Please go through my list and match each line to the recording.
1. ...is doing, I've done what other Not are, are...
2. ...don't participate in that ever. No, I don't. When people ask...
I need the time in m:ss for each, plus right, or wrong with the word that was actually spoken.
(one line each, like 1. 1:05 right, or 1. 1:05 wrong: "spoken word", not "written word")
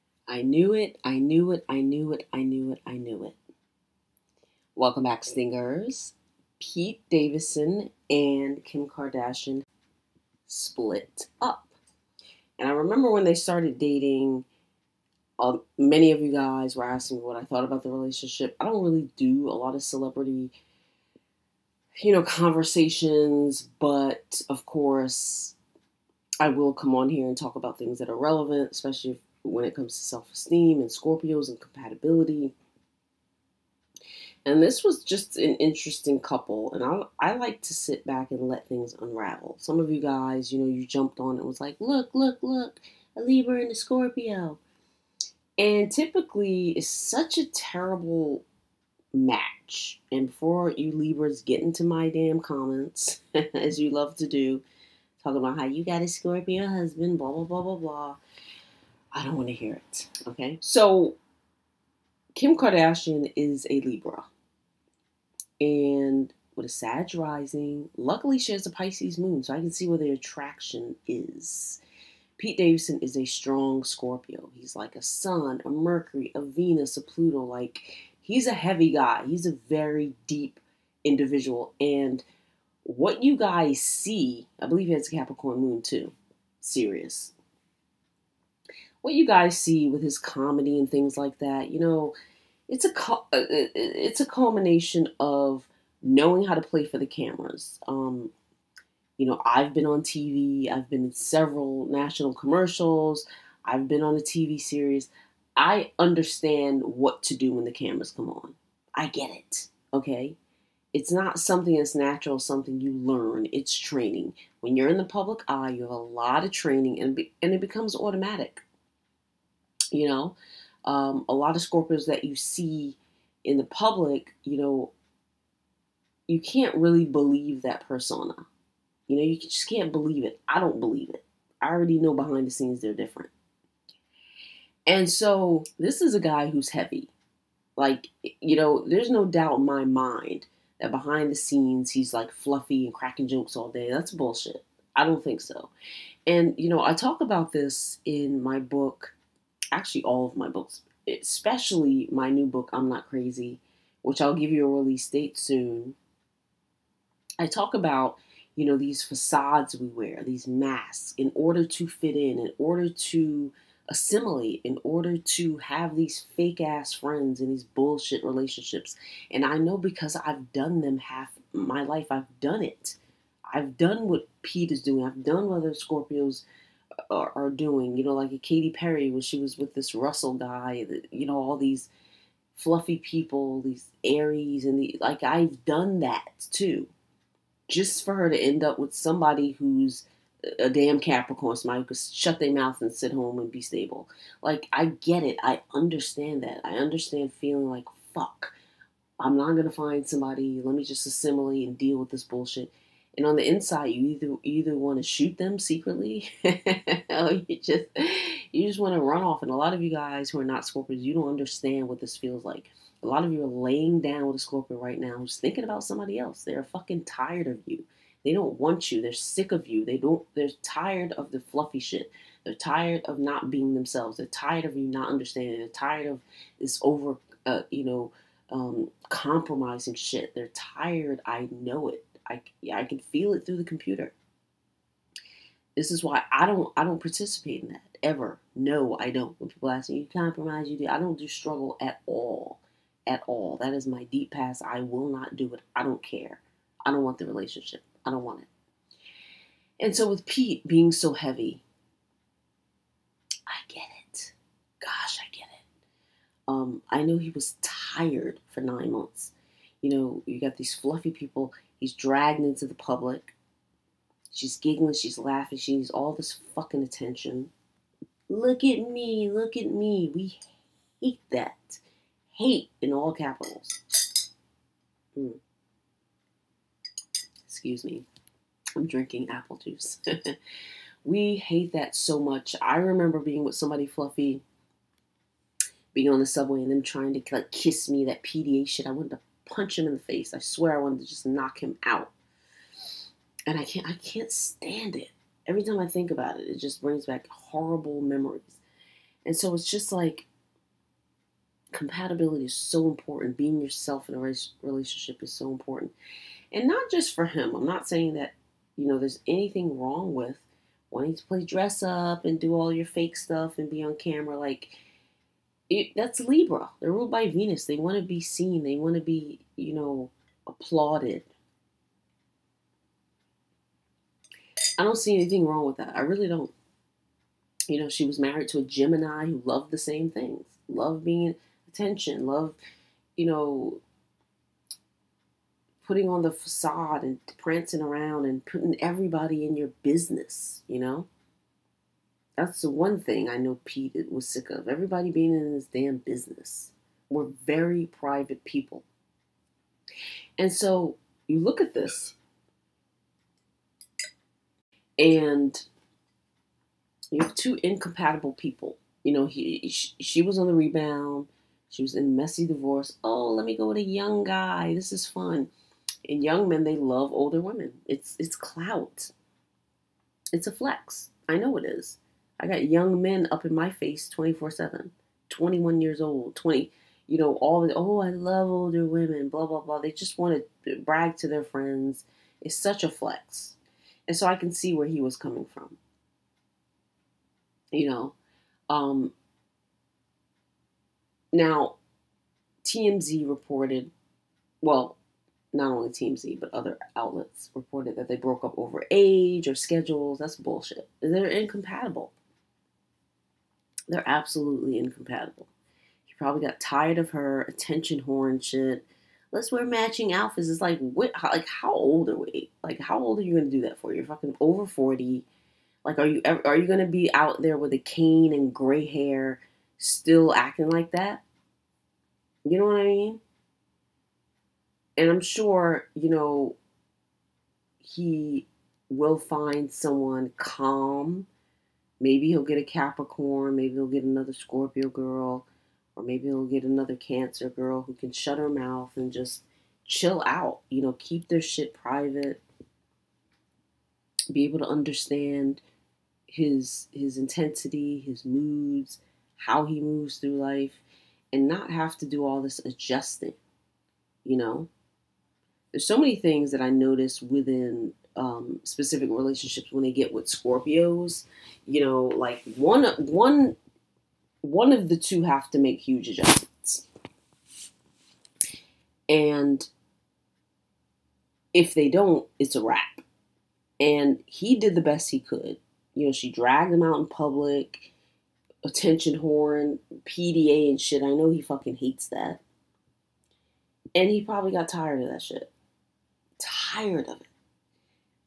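1. 2:54 wrong: "Scorpios", not "Not"
2. 3:56 right.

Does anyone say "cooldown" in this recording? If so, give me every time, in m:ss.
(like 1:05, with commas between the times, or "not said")
not said.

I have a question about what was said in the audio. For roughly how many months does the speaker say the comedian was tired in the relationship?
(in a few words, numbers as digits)
9.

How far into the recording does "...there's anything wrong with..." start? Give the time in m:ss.
5:08.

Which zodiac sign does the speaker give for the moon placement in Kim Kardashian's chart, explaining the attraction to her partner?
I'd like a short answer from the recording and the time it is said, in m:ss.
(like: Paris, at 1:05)
Pisces, at 1:08.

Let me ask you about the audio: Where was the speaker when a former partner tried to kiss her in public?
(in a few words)
On the subway.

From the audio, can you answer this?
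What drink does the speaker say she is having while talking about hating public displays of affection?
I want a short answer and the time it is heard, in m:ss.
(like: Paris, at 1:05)
Apple juice, at 4:39.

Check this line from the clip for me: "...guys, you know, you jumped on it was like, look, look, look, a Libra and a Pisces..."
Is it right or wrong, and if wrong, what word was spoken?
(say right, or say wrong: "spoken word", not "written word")
wrong: "Scorpio", not "Pisces".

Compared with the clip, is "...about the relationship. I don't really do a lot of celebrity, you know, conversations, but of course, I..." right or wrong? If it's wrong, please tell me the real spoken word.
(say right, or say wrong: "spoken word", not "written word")
right.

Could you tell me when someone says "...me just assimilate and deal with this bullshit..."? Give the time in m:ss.
3:20.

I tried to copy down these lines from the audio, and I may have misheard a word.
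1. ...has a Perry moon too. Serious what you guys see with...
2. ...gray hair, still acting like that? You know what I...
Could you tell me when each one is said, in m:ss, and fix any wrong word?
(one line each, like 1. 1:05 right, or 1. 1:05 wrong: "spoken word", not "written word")
1. 1:24 wrong: "Capricorn", not "Perry"
2. 6:58 right.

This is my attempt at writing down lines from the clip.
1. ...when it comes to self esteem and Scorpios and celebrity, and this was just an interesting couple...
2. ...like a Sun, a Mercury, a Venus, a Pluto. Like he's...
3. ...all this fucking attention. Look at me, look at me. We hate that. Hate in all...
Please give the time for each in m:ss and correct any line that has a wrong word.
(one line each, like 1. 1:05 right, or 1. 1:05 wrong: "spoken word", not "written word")
1. 0:29 wrong: "compatibility", not "celebrity"
2. 1:14 right
3. 4:25 right.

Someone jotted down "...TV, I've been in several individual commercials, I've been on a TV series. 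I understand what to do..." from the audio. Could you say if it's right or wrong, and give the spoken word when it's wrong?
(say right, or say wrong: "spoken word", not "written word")
wrong: "national", not "individual".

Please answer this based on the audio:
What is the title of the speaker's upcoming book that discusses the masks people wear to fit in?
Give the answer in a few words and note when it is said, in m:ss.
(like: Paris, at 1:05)
I'm Not Crazy, at 2:32.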